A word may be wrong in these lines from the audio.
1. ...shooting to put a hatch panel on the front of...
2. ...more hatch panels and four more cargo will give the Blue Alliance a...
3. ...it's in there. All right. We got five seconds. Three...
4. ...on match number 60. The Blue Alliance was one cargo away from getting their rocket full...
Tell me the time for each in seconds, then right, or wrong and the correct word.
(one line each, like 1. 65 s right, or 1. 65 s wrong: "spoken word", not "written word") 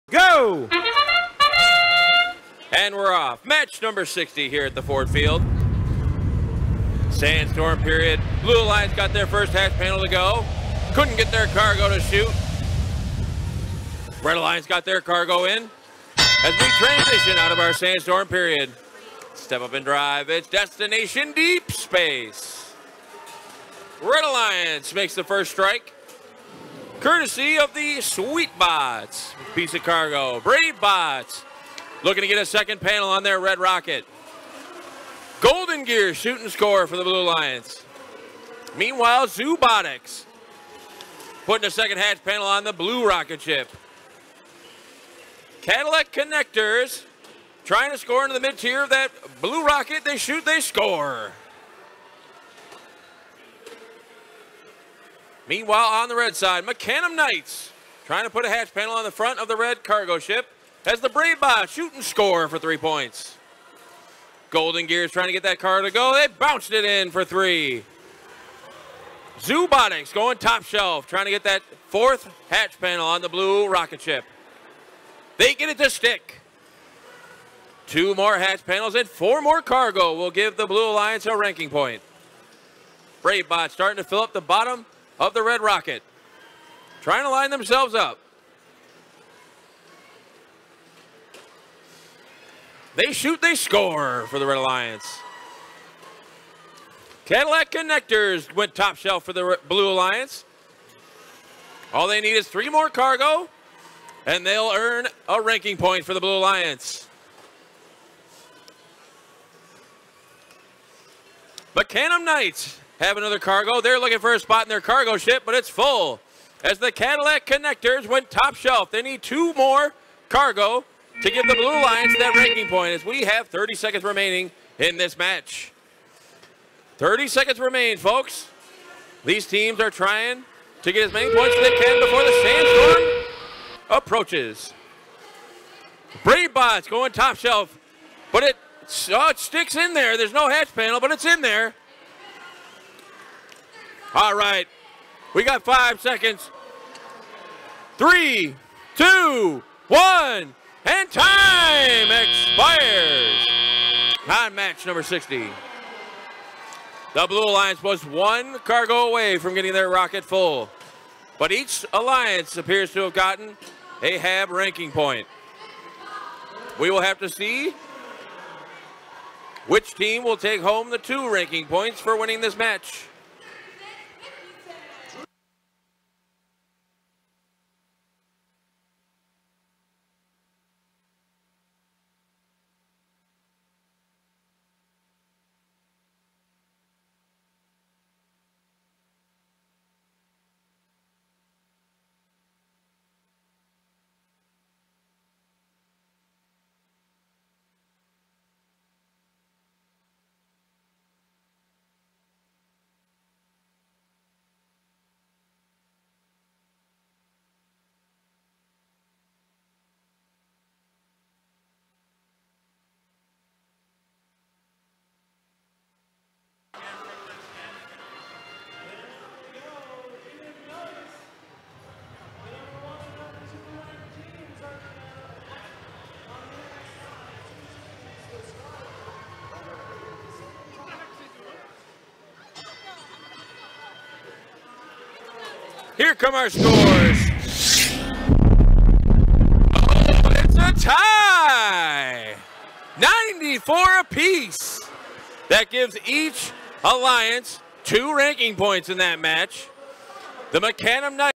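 1. 58 s wrong: "trying", not "shooting"
2. 78 s right
3. 141 s right
4. 154 s right.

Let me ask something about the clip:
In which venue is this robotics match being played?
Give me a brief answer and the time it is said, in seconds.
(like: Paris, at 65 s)
Ford Field, at 4 s.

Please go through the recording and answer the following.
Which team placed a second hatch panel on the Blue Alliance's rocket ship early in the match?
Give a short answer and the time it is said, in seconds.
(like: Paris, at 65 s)
Zoobotics, at 39 s.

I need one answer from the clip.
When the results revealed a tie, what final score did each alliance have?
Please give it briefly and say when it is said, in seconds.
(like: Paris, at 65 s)
94, at 242 s.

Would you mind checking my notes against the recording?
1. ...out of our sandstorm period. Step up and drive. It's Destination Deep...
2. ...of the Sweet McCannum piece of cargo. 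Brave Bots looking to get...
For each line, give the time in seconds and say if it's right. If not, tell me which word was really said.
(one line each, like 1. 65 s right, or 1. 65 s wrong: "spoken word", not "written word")
1. 17 s right
2. 27 s wrong: "Bots", not "McCannum".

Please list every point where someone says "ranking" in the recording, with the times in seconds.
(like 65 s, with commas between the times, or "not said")
81 s, 105 s, 122 s, 164 s, 171 s, 248 s.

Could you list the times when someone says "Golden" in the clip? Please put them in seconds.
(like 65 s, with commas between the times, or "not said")
35 s, 64 s.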